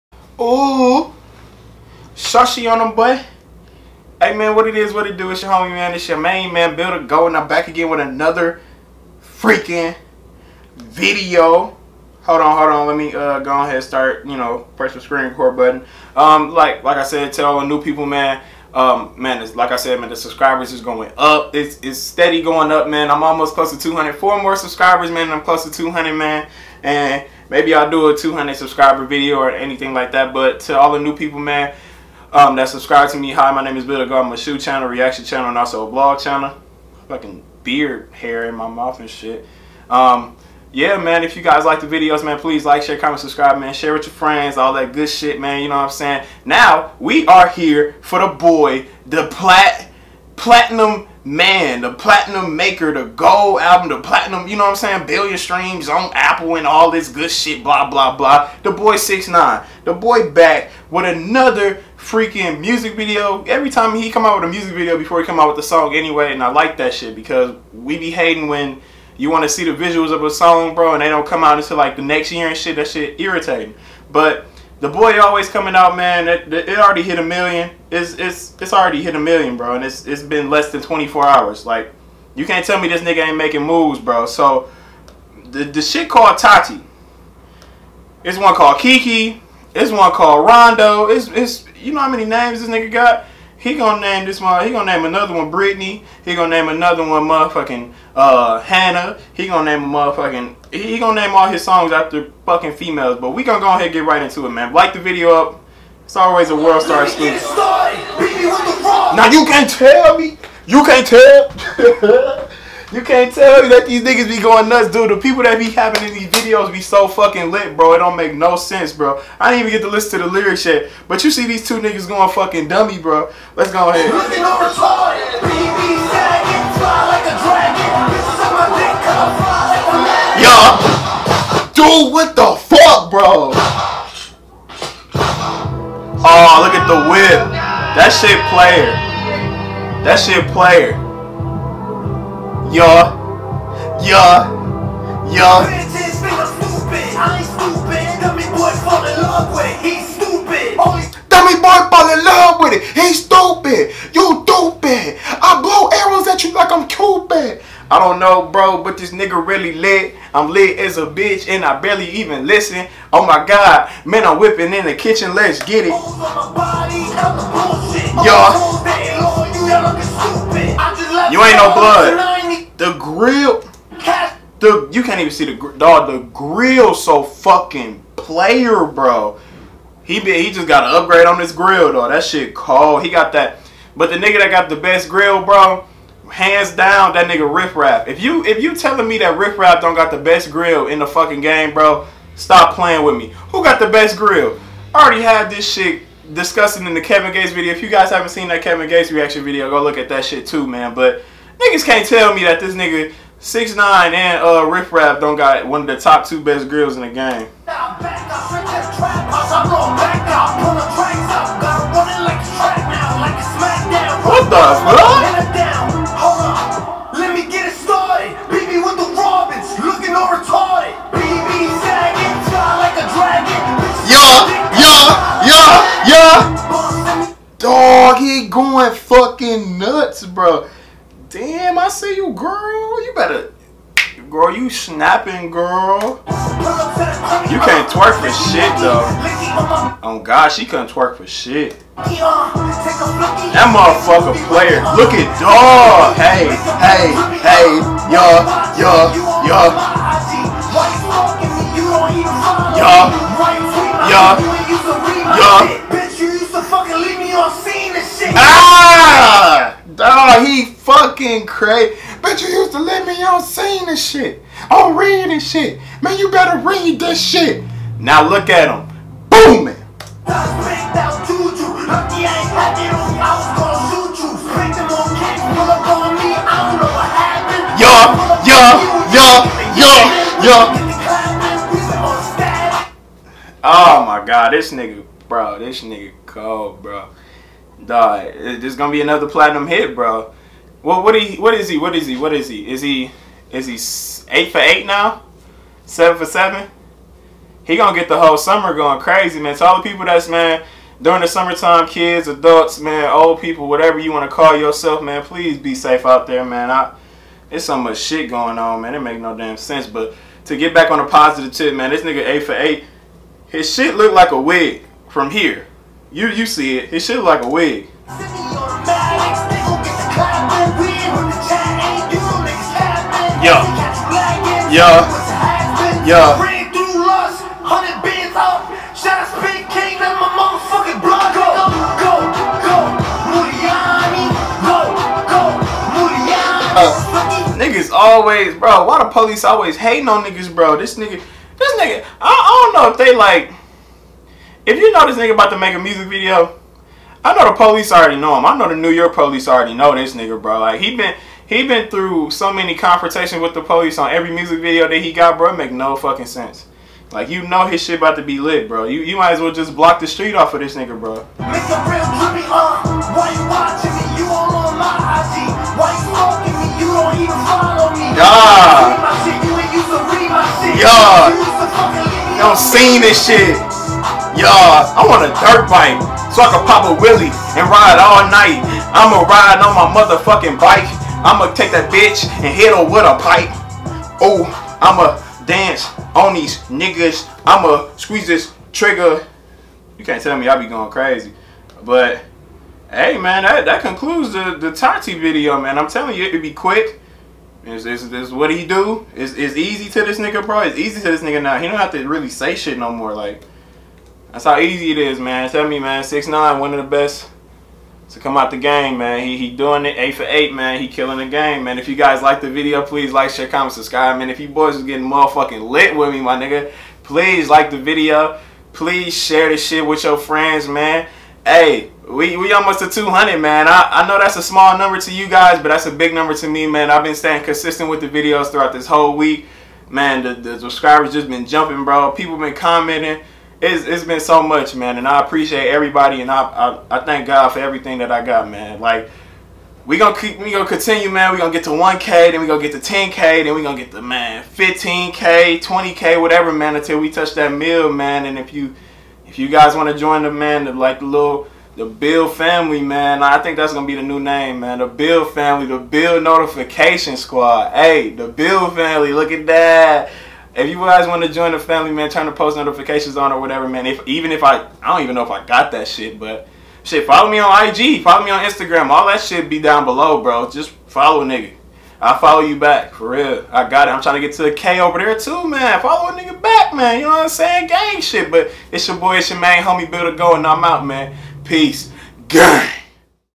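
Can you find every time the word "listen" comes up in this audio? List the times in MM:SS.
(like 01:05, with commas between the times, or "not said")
01:59, 02:42.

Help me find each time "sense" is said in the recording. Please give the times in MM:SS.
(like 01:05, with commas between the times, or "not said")
01:58, 05:09, 05:56.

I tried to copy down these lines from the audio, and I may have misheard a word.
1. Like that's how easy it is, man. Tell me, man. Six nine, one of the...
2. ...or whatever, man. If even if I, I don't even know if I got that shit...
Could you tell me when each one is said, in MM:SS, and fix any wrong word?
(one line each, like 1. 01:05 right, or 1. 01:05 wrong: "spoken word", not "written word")
1. 06:43 right
2. 07:43 right.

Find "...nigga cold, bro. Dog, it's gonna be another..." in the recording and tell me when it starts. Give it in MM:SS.
04:45.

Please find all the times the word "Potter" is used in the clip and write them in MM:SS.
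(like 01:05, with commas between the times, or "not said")
not said.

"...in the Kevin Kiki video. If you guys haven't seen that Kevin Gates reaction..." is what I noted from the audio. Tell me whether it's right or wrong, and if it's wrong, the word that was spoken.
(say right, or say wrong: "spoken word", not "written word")
wrong: "Gates", not "Kiki".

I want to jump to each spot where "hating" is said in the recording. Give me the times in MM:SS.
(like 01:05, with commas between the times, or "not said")
01:08, 05:39.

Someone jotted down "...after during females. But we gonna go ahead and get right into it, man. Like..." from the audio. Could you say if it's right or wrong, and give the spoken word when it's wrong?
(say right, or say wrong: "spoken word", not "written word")
wrong: "fucking", not "during".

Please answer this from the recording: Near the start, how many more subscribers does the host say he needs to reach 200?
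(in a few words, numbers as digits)
4.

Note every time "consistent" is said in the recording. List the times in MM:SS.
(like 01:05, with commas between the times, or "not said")
07:07.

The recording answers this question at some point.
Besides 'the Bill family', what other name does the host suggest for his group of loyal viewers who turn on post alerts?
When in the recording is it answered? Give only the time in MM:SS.
07:35.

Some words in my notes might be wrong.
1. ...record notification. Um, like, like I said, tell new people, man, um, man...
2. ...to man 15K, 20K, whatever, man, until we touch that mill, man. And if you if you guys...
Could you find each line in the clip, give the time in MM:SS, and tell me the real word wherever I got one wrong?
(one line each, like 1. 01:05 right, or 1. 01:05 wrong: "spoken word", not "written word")
1. 00:15 wrong: "button", not "notification"
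2. 07:23 right.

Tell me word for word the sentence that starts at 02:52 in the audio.
The grill, the you can't even see the dog.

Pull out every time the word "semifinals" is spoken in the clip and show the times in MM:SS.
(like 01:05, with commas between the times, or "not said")
not said.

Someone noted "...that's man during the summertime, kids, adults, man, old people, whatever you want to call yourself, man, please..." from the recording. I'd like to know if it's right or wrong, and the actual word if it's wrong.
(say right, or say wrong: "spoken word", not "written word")
right.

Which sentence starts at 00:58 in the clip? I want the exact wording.
The boy six nine, the boy back with another freaking music video.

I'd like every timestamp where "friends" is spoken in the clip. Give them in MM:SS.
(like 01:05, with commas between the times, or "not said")
00:44, 07:00.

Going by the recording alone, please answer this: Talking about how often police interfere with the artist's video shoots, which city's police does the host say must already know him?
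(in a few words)
New York.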